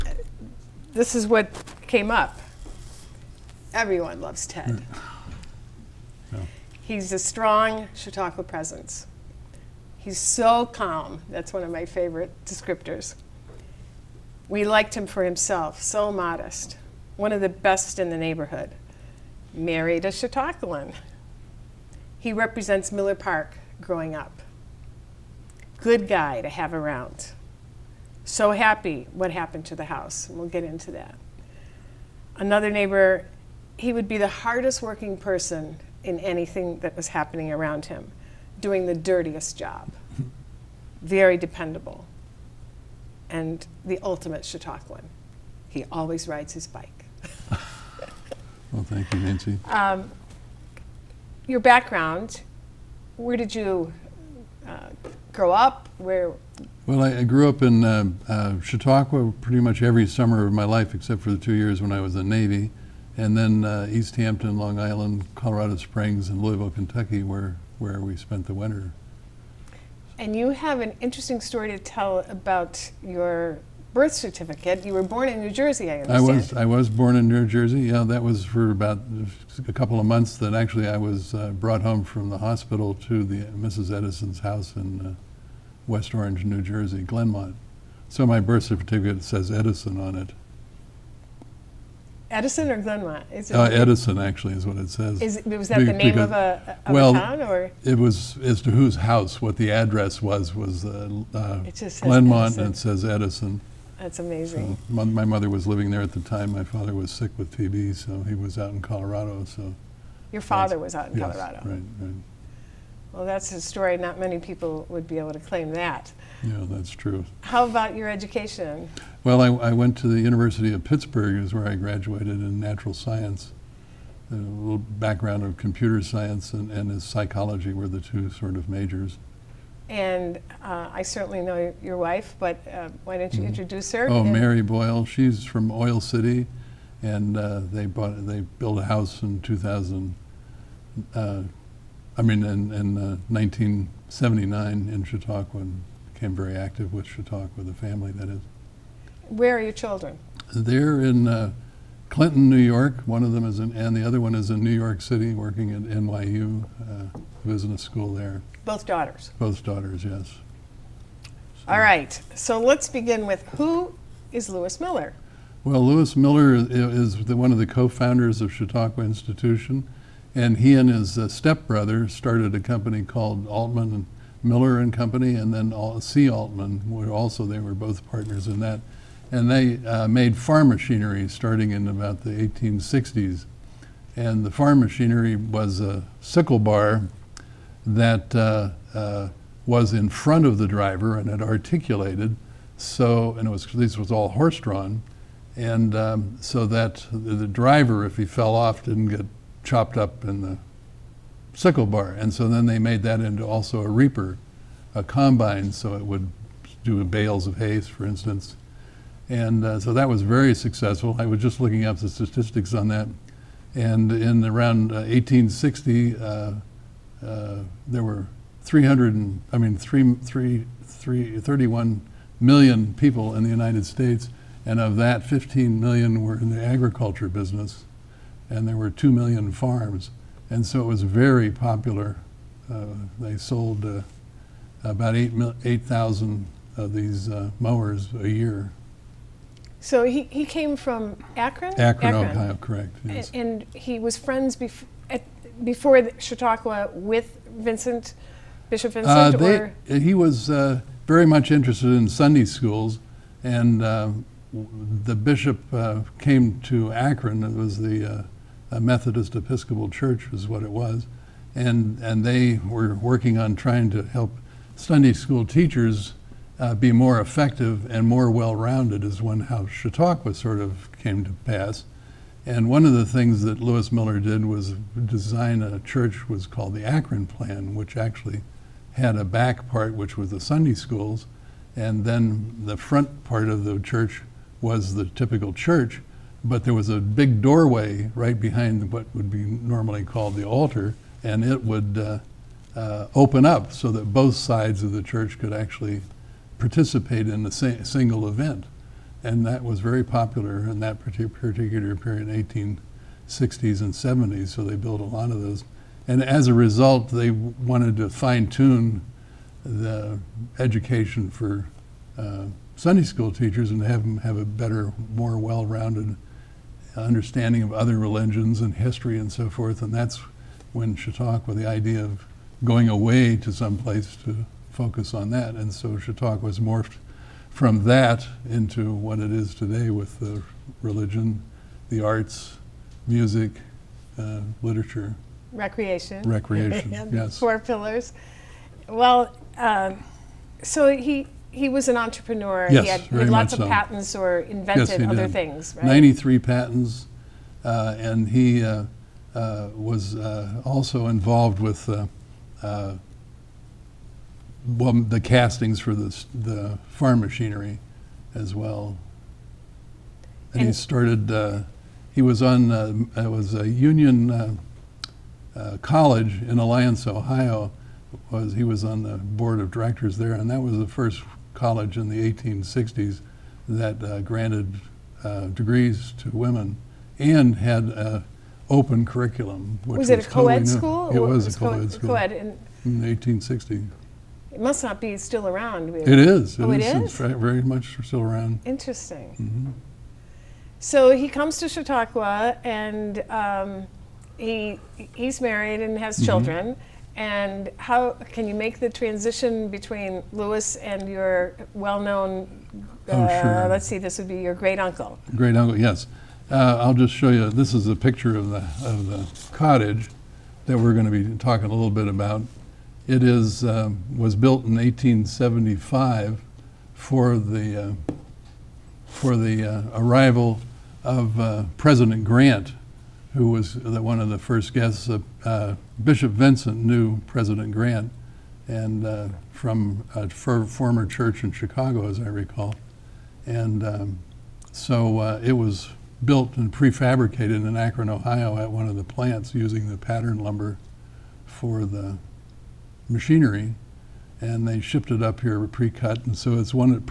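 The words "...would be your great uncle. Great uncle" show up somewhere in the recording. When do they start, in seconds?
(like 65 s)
404 s.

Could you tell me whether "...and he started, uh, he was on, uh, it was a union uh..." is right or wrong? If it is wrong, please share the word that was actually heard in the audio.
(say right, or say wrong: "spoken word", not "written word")
right.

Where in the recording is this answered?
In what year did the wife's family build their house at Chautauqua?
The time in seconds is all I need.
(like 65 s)
143 s.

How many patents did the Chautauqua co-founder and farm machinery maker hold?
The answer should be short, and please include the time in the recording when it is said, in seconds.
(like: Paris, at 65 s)
93, at 345 s.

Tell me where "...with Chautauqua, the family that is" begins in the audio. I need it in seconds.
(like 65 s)
146 s.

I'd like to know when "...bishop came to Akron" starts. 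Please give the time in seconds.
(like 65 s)
255 s.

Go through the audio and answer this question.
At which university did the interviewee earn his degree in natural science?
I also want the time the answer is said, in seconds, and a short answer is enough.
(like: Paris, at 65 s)
University of Pittsburgh, at 120 s.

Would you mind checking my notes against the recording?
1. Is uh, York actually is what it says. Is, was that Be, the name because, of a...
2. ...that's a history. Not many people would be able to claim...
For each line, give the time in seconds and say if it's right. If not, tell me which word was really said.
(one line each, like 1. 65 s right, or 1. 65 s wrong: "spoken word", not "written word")
1. 93 s wrong: "Edison", not "York"
2. 113 s wrong: "story", not "history".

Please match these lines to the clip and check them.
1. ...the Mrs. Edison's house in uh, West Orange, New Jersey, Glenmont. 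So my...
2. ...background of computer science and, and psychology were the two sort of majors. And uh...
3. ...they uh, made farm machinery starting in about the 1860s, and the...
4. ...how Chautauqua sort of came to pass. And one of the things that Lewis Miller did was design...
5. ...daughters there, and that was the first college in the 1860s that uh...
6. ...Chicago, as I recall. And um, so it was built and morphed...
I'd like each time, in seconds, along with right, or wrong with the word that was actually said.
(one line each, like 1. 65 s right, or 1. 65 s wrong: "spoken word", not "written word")
1. 83 s right
2. 124 s right
3. 179 s right
4. 269 s right
5. 369 s wrong: "directors", not "daughters"
6. 431 s wrong: "prefabricated", not "morphed".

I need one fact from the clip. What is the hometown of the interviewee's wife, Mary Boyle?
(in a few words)
Oil City.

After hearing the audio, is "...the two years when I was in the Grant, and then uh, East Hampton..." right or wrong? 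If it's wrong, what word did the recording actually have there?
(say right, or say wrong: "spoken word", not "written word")
wrong: "Navy", not "Grant".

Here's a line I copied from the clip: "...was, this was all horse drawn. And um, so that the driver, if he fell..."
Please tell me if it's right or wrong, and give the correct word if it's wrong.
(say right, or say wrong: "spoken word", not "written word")
right.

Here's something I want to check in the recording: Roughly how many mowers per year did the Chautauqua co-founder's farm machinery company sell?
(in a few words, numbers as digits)
8,000.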